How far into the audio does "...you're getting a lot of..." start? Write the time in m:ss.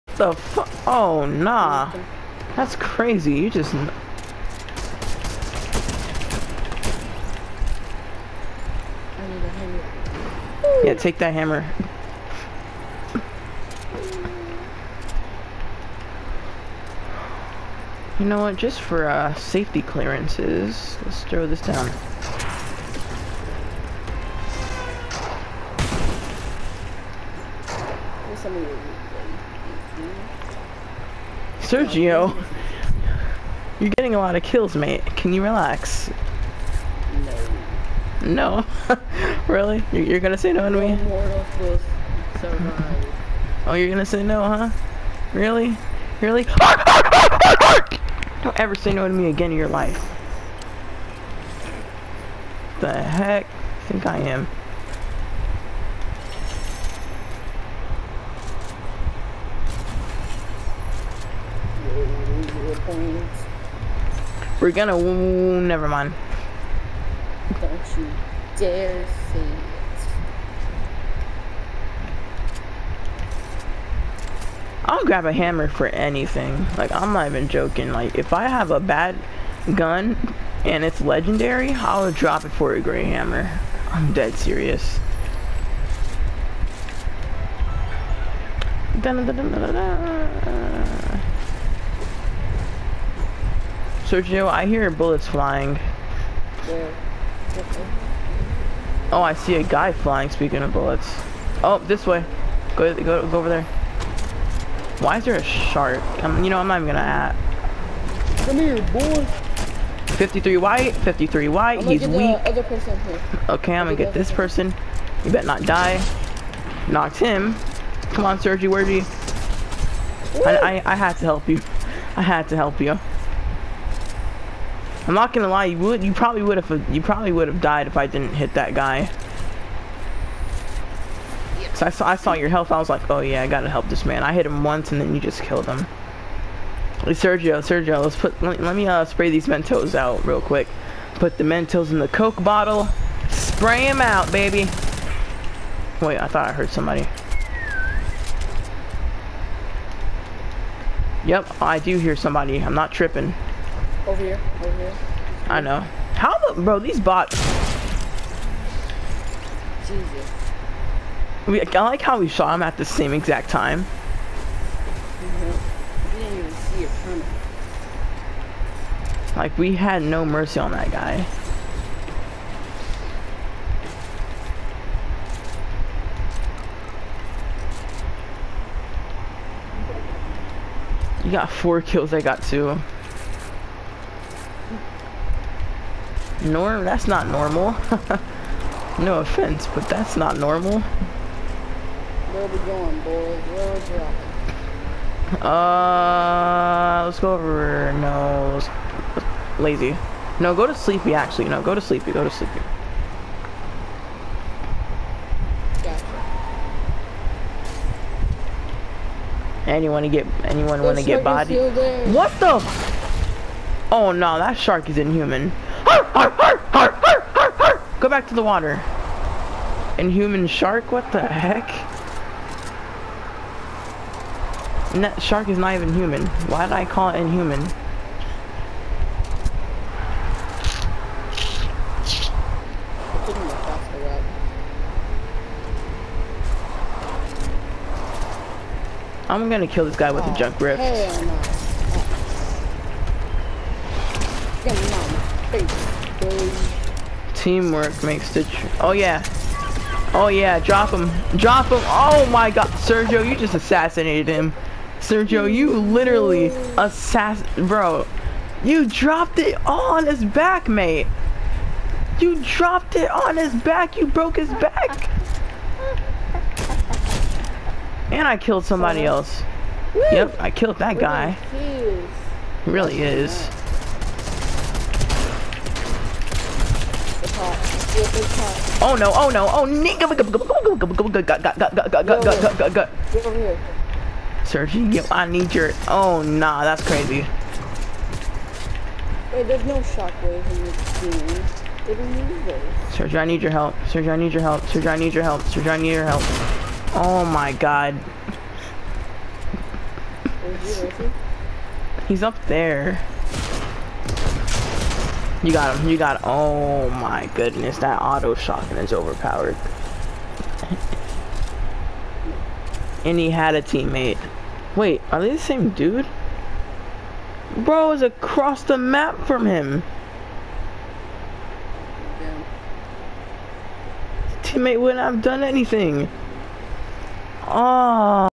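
0:33.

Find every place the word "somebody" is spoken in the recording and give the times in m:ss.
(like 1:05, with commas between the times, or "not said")
2:26, 2:32, 4:28.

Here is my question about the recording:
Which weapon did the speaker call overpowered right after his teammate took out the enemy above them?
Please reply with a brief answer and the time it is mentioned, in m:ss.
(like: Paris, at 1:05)
auto shotgun, at 5:08.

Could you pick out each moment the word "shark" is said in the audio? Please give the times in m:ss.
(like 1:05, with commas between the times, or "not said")
1:45, 3:34, 3:40, 3:45.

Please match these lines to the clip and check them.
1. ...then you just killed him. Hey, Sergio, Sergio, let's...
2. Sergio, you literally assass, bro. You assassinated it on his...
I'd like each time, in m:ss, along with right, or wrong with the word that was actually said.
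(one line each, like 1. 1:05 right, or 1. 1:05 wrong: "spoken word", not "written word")
1. 2:15 right
2. 4:15 wrong: "dropped", not "assassinated".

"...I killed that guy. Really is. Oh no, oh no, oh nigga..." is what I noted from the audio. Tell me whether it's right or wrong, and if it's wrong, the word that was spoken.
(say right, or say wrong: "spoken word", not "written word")
right.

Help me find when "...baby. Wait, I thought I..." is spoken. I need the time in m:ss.
2:24.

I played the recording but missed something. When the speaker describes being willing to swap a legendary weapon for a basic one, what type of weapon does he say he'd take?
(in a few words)
gray hammer.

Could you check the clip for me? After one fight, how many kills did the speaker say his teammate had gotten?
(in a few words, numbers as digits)
4.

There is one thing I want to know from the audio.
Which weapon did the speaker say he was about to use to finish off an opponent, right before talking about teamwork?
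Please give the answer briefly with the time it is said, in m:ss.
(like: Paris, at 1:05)
junk rift, at 4:00.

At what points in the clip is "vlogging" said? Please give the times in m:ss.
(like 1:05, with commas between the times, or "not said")
not said.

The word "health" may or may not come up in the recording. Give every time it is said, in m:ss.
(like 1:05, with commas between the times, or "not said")
2:12.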